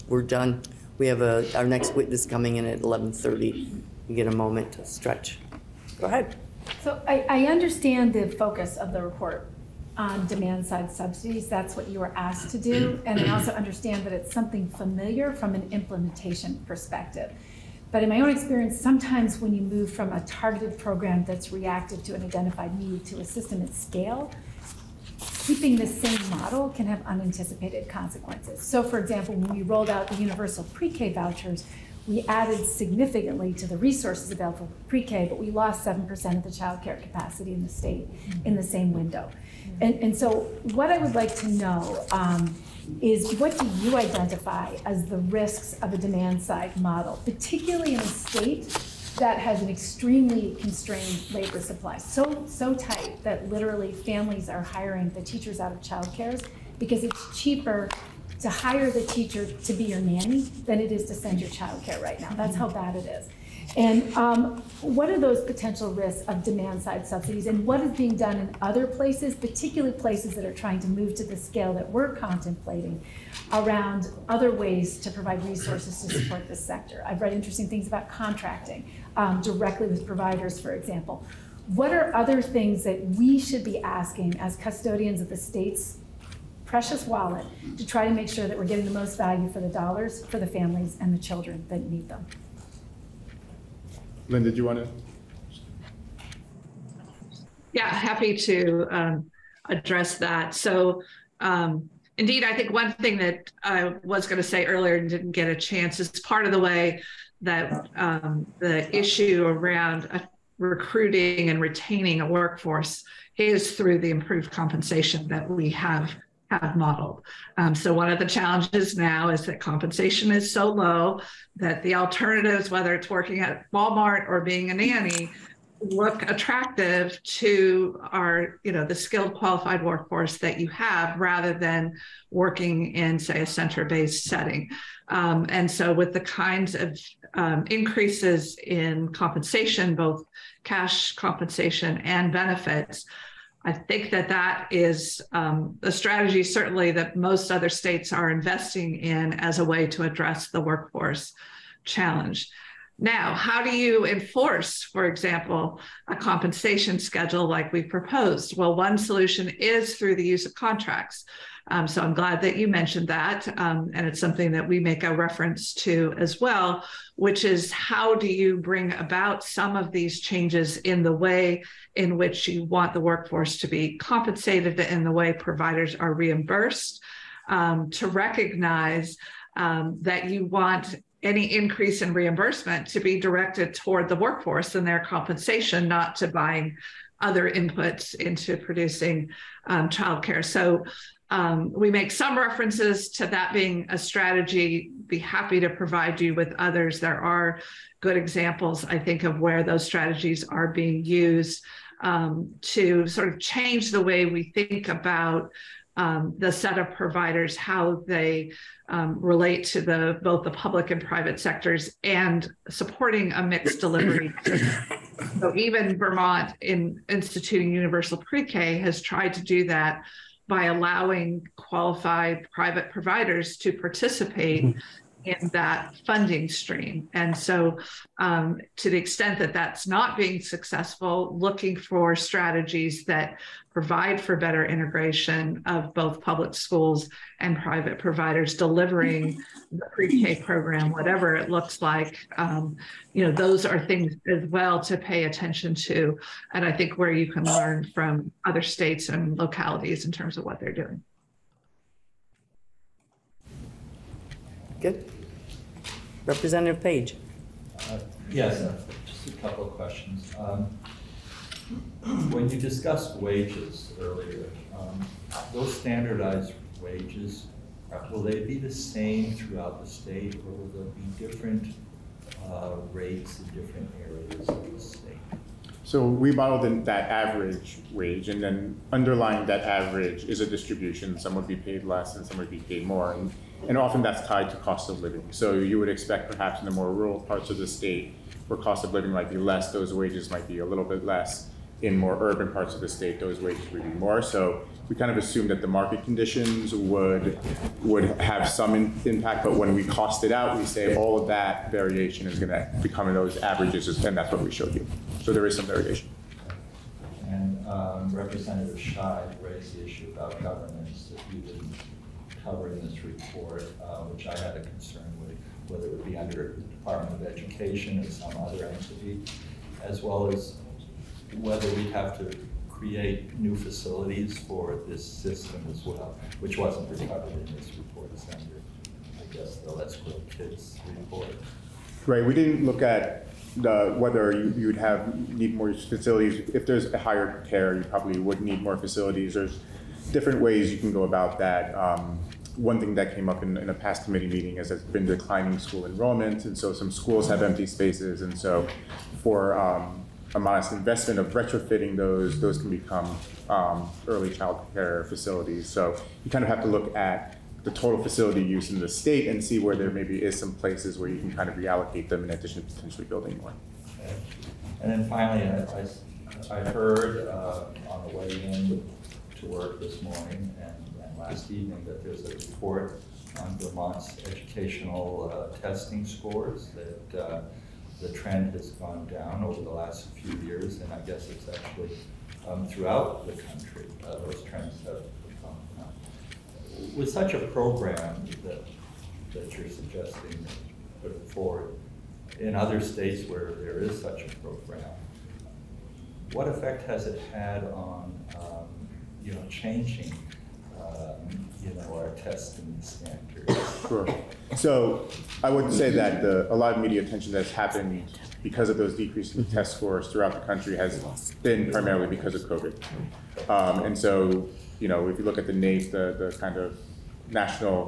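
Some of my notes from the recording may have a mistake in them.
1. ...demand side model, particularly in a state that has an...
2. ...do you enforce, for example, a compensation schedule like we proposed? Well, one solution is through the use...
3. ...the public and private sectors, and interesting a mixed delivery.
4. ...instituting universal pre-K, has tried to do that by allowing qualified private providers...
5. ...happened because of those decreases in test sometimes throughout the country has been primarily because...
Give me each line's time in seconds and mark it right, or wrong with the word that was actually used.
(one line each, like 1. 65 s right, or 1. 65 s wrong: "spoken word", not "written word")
1. 45 s right
2. 153 s right
3. 210 s wrong: "supporting", not "interesting"
4. 217 s right
5. 407 s wrong: "scores", not "sometimes".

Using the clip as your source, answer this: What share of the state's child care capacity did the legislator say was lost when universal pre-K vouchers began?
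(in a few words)
7%.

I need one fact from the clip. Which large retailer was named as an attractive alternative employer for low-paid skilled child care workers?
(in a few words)
Walmart.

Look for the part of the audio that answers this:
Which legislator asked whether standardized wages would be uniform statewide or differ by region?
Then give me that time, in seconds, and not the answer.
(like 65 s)
256 s.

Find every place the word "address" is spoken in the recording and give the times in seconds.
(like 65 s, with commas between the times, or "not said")
99 s, 150 s.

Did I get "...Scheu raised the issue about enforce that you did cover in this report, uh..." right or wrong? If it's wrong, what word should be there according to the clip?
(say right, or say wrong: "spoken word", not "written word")
wrong: "governance", not "enforce".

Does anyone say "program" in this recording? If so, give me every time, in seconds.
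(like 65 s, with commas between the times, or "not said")
20 s, 240 s, 387 s, 394 s.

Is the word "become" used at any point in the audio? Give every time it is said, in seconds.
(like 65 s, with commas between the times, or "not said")
302 s, 352 s.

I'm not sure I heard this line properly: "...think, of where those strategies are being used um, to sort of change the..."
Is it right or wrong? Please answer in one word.
right.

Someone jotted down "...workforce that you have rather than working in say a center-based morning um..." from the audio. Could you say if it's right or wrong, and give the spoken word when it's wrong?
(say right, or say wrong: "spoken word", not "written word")
wrong: "setting", not "morning".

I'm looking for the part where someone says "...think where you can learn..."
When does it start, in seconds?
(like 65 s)
246 s.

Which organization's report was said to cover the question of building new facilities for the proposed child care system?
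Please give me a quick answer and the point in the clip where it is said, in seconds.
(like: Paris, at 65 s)
Let's Grow Kids, at 329 s.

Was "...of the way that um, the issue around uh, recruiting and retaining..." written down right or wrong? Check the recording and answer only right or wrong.
right.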